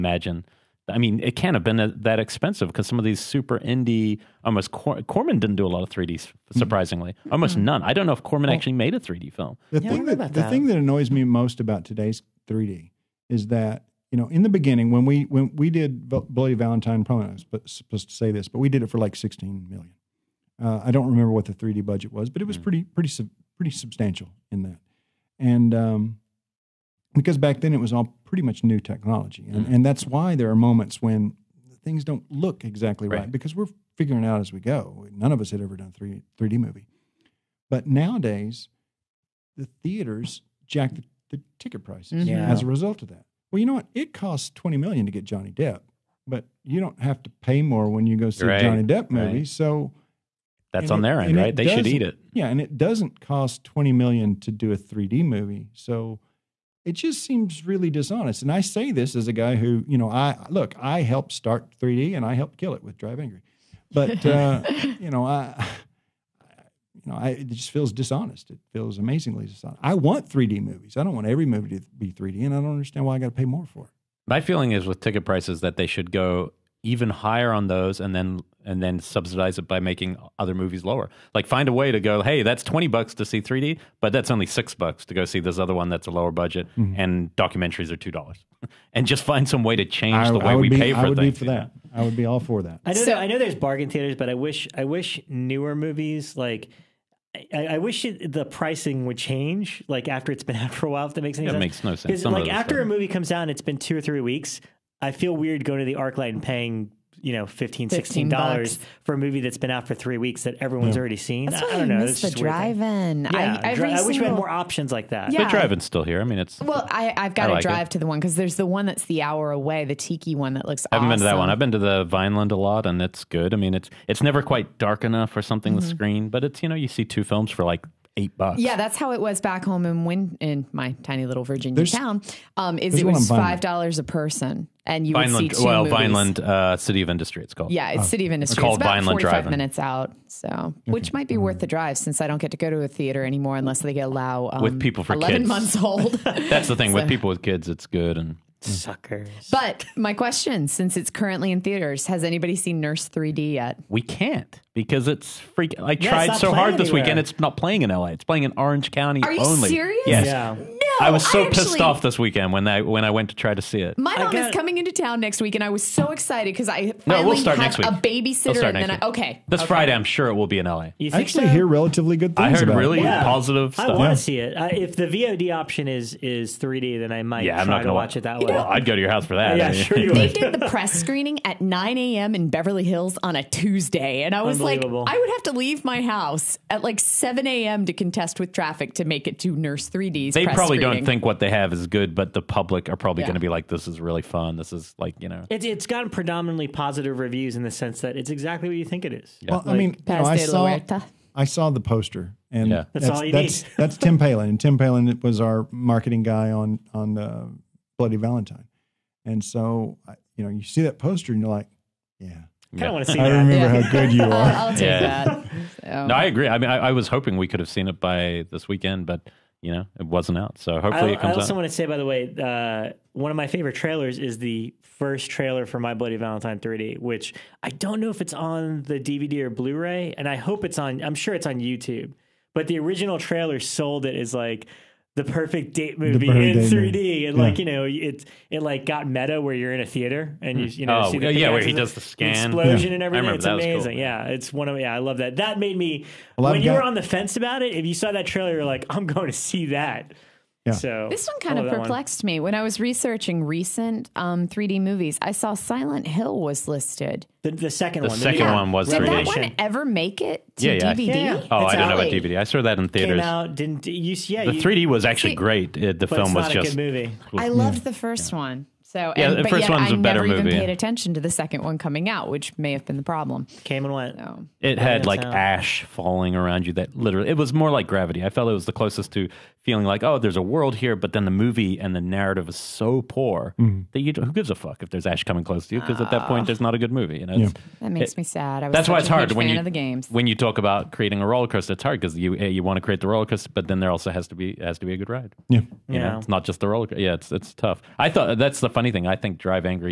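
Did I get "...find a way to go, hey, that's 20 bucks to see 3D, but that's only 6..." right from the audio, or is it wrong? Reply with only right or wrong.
right.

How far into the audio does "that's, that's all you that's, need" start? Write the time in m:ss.
3:22.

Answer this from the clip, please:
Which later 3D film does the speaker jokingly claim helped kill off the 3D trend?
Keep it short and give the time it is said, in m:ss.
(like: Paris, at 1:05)
Drive Angry, at 1:02.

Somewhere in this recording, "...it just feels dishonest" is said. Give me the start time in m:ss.
1:07.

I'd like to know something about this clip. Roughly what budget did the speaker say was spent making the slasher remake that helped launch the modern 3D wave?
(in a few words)
16 million.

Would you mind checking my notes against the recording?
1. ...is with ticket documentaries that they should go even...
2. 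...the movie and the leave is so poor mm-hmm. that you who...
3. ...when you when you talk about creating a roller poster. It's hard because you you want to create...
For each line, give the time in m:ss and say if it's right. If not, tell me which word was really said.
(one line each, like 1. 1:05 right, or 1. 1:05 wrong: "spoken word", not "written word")
1. 1:14 wrong: "prices", not "documentaries"
2. 4:41 wrong: "narrative", not "leave"
3. 4:49 wrong: "coaster", not "poster".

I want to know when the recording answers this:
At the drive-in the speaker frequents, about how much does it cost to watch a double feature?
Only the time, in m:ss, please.
2:08.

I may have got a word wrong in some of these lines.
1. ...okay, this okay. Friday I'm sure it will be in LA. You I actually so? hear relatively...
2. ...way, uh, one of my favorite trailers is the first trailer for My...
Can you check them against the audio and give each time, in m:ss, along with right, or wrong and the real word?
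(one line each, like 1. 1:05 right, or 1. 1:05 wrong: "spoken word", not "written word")
1. 2:49 right
2. 3:42 right.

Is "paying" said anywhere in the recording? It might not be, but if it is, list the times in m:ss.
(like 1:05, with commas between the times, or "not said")
1:46.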